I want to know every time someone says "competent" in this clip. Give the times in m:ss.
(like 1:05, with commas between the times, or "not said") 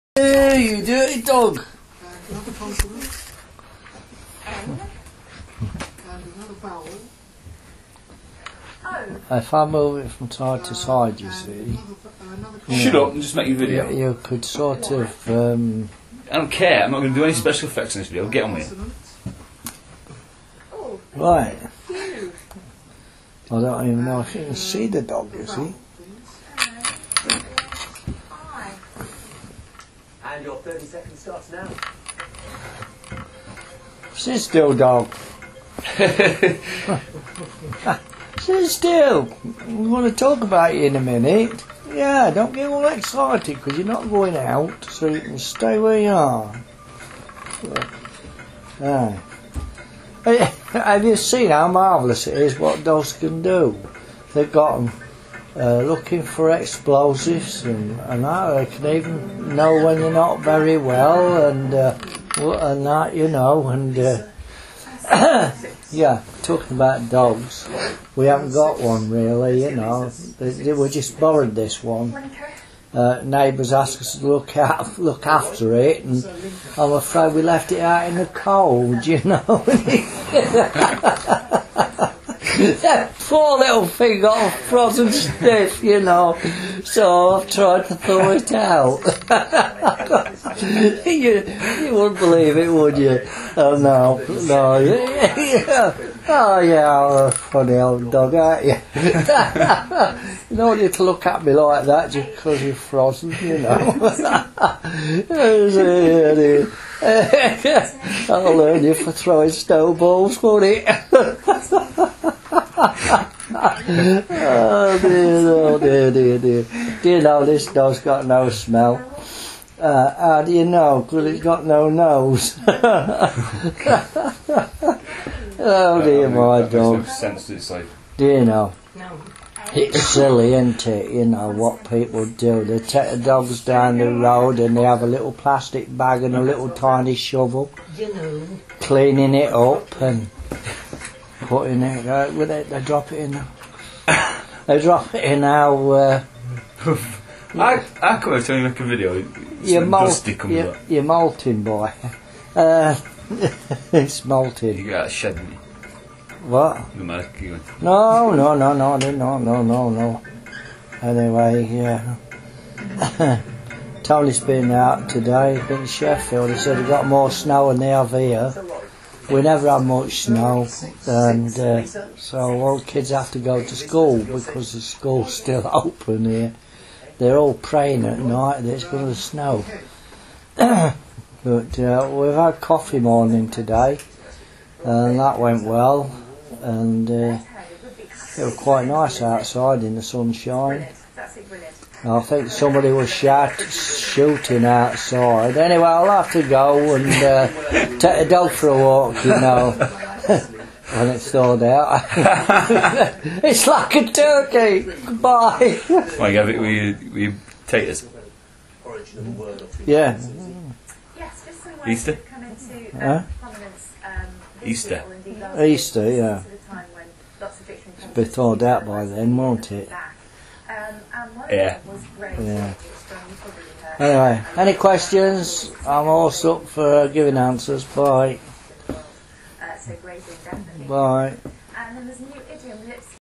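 not said.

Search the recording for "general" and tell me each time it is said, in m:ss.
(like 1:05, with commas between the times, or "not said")
not said.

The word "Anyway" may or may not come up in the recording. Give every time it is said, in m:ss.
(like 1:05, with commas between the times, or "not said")
2:41, 3:15.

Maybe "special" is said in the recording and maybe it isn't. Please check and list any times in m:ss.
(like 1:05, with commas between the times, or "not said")
0:17.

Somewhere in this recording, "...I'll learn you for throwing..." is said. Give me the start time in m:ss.
1:48.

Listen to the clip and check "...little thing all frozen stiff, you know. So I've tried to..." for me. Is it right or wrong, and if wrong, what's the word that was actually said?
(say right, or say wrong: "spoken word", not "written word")
right.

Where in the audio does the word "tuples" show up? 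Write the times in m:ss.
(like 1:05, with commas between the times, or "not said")
not said.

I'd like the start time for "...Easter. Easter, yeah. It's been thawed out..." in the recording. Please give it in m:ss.
3:34.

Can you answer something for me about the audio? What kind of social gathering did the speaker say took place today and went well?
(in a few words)
coffee morning.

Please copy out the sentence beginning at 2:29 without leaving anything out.
you're, molting, you're, you're, molting, boy.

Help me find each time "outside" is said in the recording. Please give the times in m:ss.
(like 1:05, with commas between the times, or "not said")
3:09, 3:14.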